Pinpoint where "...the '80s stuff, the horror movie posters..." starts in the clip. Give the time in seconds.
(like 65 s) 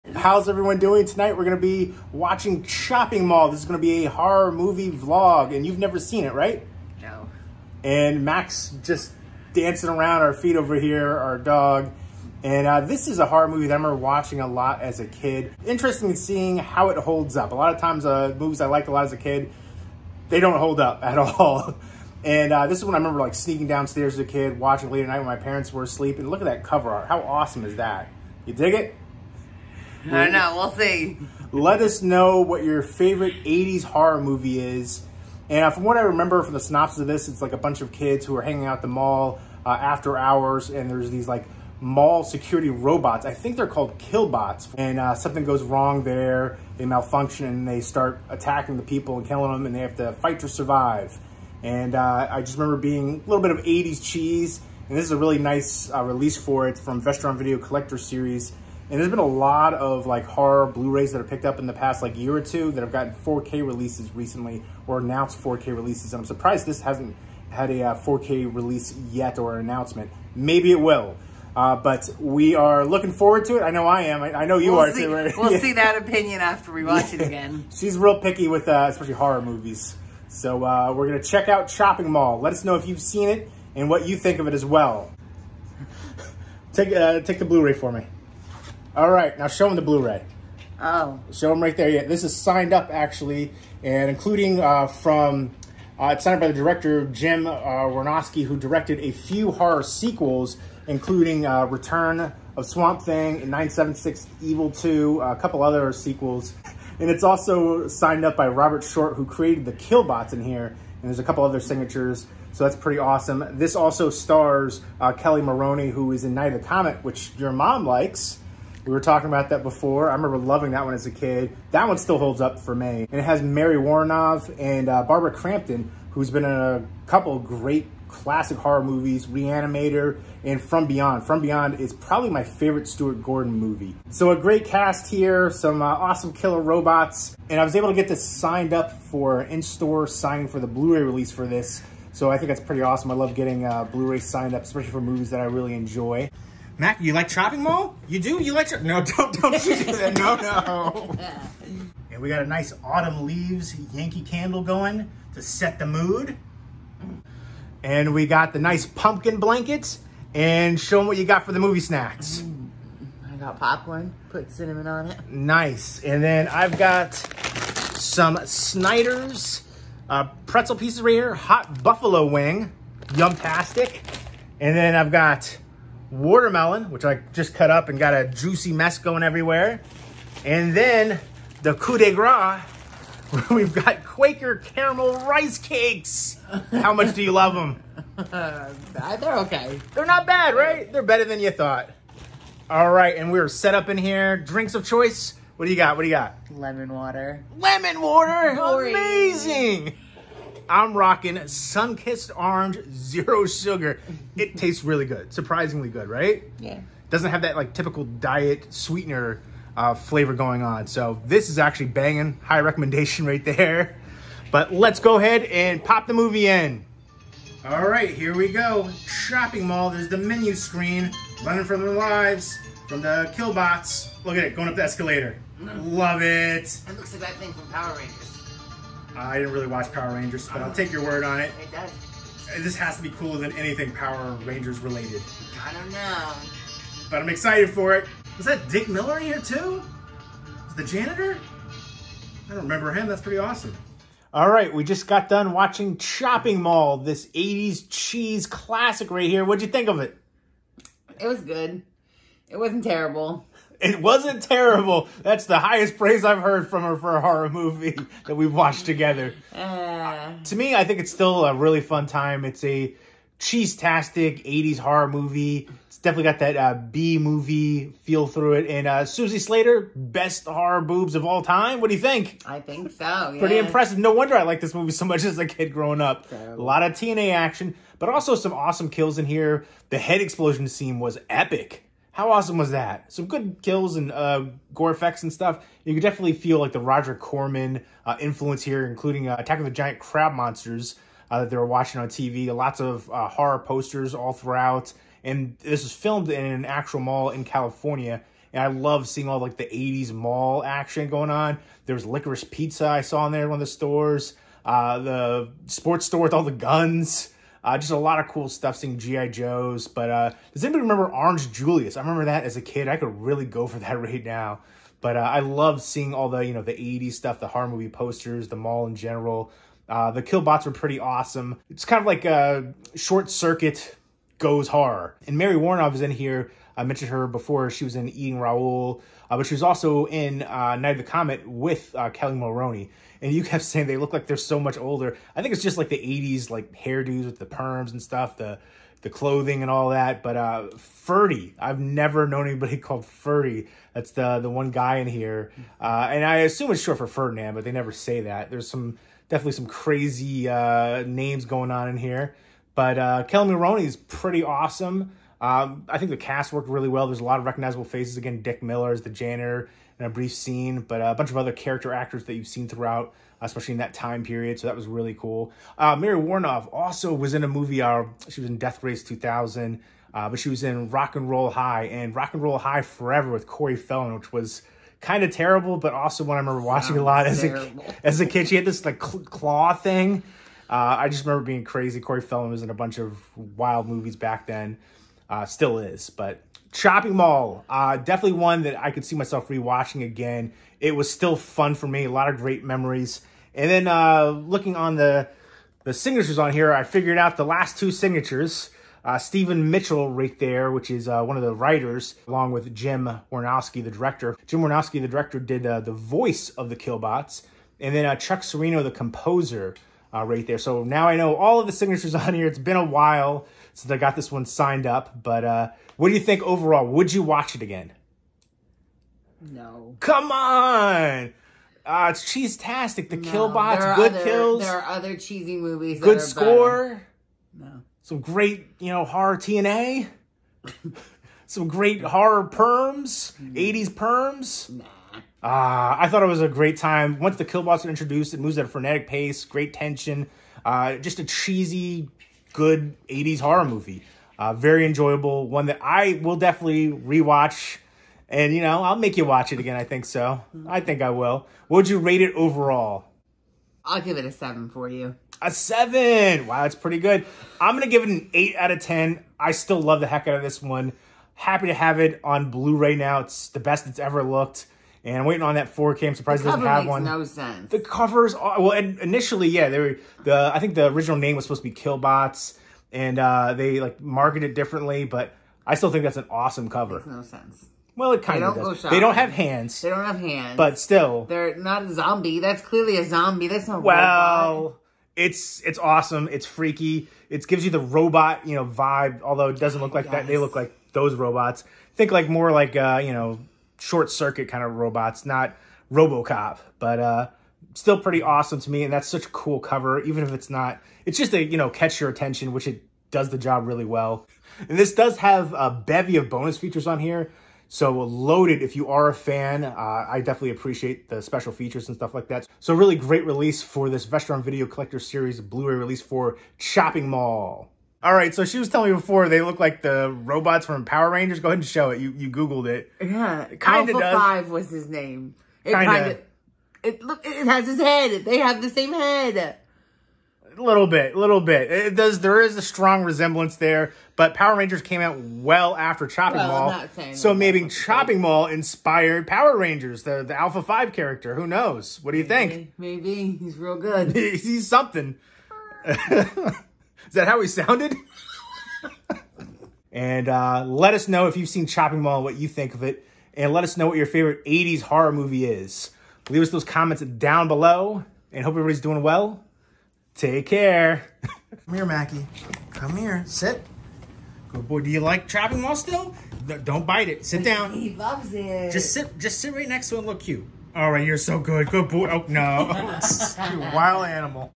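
316 s.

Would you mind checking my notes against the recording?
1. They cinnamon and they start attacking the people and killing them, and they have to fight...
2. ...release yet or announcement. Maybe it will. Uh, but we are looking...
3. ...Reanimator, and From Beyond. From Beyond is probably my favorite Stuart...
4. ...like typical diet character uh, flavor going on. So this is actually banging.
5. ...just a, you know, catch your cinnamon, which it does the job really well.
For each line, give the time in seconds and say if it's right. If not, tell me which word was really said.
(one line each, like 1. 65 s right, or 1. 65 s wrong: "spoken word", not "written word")
1. 46 s wrong: "malfunction", not "cinnamon"
2. 68 s right
3. 129 s right
4. 207 s wrong: "sweetener", not "character"
5. 501 s wrong: "attention", not "cinnamon".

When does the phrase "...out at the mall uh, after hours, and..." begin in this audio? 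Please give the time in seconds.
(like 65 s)
38 s.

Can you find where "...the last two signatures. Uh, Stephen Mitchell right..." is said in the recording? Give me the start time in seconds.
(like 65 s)
397 s.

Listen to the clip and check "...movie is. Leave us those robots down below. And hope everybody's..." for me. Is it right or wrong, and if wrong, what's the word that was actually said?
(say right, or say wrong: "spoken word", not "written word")
wrong: "comments", not "robots".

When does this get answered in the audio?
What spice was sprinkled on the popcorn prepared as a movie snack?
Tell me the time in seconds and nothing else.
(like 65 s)
164 s.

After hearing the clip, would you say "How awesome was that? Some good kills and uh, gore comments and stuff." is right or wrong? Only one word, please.
wrong.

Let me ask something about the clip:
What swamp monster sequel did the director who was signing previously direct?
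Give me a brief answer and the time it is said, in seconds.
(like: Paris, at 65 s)
Return of Swamp Thing, at 101 s.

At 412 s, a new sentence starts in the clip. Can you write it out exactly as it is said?
It's been a while since I got this one signed up.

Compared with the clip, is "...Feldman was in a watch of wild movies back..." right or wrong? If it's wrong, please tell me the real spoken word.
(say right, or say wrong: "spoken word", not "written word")
wrong: "bunch", not "watch".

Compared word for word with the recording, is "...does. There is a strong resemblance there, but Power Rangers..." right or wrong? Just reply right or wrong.
right.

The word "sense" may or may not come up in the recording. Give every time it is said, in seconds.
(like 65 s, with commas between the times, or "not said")
467 s, 477 s.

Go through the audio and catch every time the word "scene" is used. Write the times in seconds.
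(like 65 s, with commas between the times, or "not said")
280 s, 360 s.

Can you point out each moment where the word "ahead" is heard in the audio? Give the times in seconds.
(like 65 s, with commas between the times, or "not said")
215 s, 521 s.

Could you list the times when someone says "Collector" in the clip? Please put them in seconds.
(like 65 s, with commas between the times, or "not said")
57 s, 514 s.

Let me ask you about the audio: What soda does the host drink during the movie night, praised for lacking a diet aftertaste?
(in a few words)
Sunkist Orange Zero Sugar.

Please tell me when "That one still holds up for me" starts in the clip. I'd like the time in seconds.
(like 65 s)
121 s.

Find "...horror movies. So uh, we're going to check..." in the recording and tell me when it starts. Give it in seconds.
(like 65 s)
79 s.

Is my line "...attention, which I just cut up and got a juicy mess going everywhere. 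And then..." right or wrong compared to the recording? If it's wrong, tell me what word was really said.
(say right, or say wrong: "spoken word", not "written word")
wrong: "watermelon", not "attention".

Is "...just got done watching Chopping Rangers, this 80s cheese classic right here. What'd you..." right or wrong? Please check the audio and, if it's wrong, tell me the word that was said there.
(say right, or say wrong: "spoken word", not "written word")
wrong: "Mall", not "Rangers".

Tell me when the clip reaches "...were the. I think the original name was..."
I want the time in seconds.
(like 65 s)
469 s.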